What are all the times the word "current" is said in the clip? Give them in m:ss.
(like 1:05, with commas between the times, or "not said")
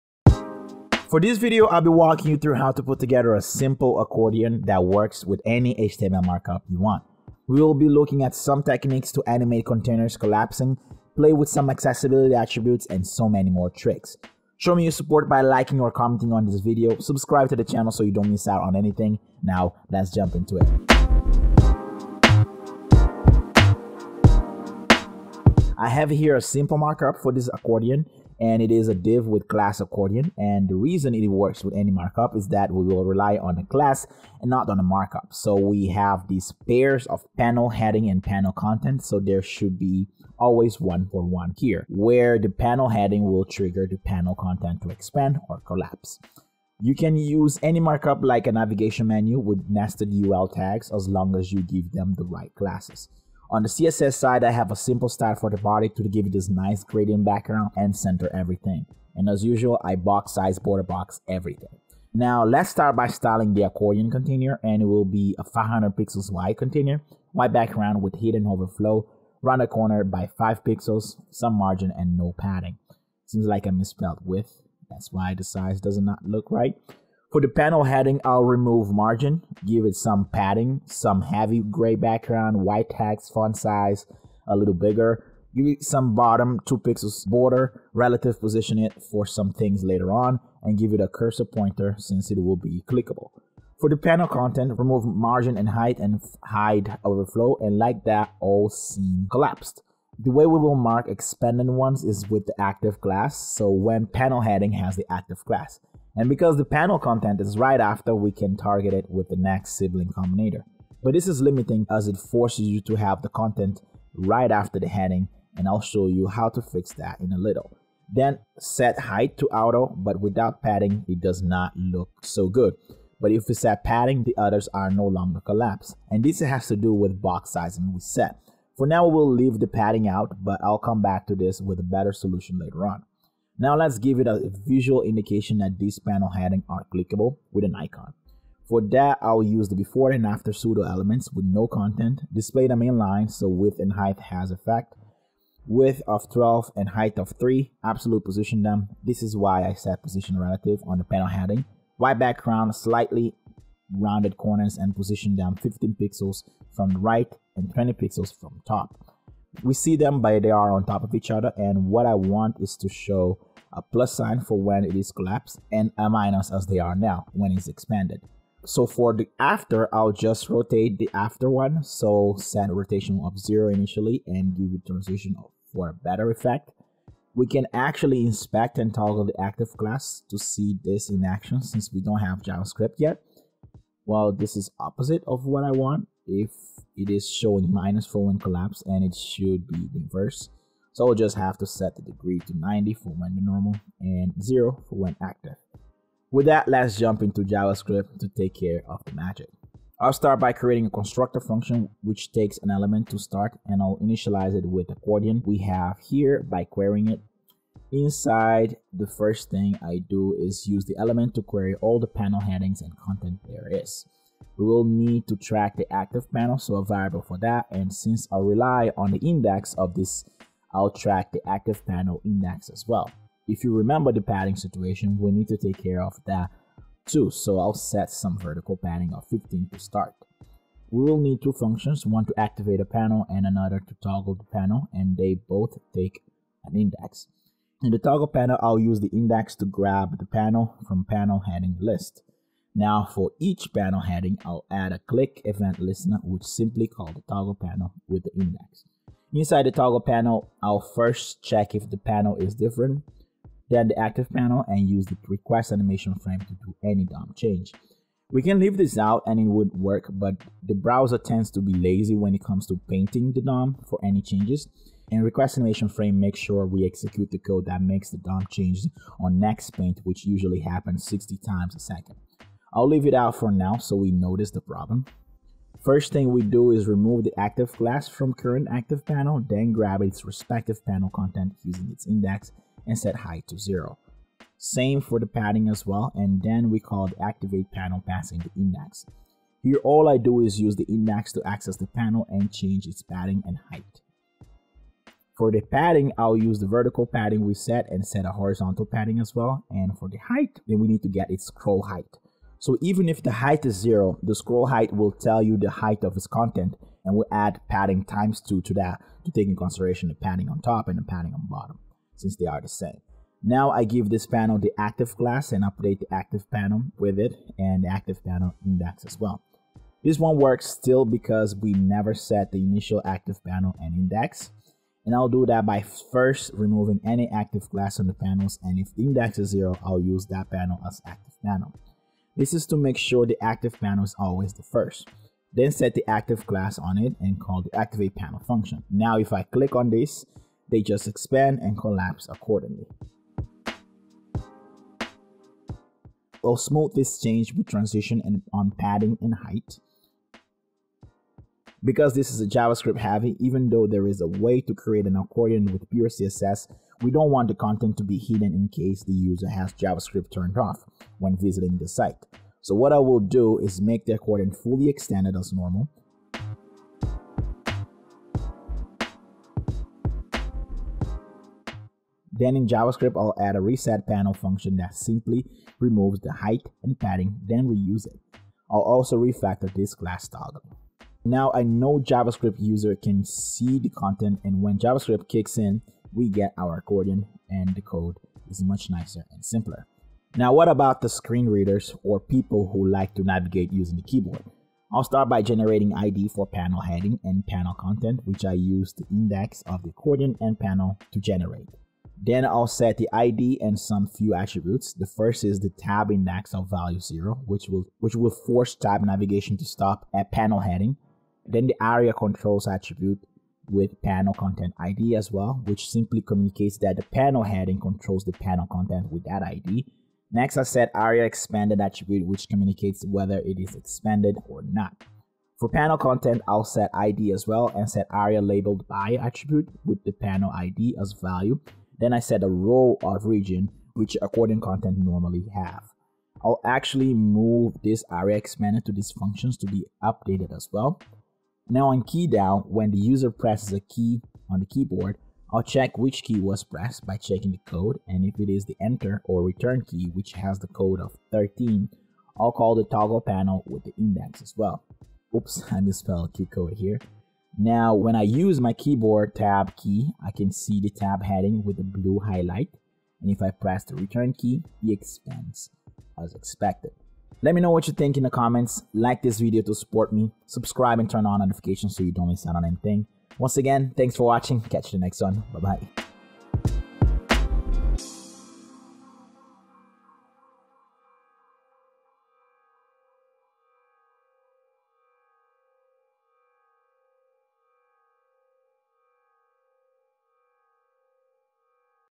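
4:38.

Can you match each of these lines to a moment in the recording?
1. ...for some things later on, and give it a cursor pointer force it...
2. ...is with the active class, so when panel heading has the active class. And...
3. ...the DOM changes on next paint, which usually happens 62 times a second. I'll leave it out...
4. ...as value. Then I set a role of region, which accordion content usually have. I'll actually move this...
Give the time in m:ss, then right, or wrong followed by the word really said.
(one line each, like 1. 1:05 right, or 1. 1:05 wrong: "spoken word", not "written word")
1. 1:29 wrong: "since", not "force"
2. 1:42 right
3. 4:28 wrong: "60", not "62"
4. 7:10 wrong: "normally", not "usually".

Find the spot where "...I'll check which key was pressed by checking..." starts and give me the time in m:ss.
7:25.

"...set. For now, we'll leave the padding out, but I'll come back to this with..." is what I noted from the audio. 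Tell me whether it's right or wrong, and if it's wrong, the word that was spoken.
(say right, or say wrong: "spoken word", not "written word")
right.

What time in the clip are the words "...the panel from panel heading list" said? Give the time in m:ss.
4:00.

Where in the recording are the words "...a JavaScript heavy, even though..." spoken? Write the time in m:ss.
5:52.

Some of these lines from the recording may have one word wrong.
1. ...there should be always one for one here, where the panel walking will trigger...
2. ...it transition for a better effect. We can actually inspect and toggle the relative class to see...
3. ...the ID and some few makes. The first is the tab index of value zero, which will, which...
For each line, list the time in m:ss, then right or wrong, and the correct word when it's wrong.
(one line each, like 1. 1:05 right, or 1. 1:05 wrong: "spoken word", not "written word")
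1. 0:39 wrong: "heading", not "walking"
2. 2:54 wrong: "active", not "relative"
3. 6:42 wrong: "attributes", not "makes".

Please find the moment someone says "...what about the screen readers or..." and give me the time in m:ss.
6:30.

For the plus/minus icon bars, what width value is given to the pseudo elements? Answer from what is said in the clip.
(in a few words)
12.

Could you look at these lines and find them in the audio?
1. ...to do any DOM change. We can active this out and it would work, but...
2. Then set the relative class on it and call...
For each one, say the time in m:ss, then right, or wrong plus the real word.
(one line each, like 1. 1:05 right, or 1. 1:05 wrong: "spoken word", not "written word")
1. 4:16 wrong: "leave", not "active"
2. 5:35 wrong: "active", not "relative".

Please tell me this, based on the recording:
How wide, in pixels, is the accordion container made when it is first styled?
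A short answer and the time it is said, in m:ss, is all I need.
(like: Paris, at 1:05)
500 pixels, at 1:05.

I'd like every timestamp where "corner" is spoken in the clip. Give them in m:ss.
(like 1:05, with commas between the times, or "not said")
1:09, 2:34.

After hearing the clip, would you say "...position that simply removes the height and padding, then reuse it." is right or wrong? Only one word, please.
wrong.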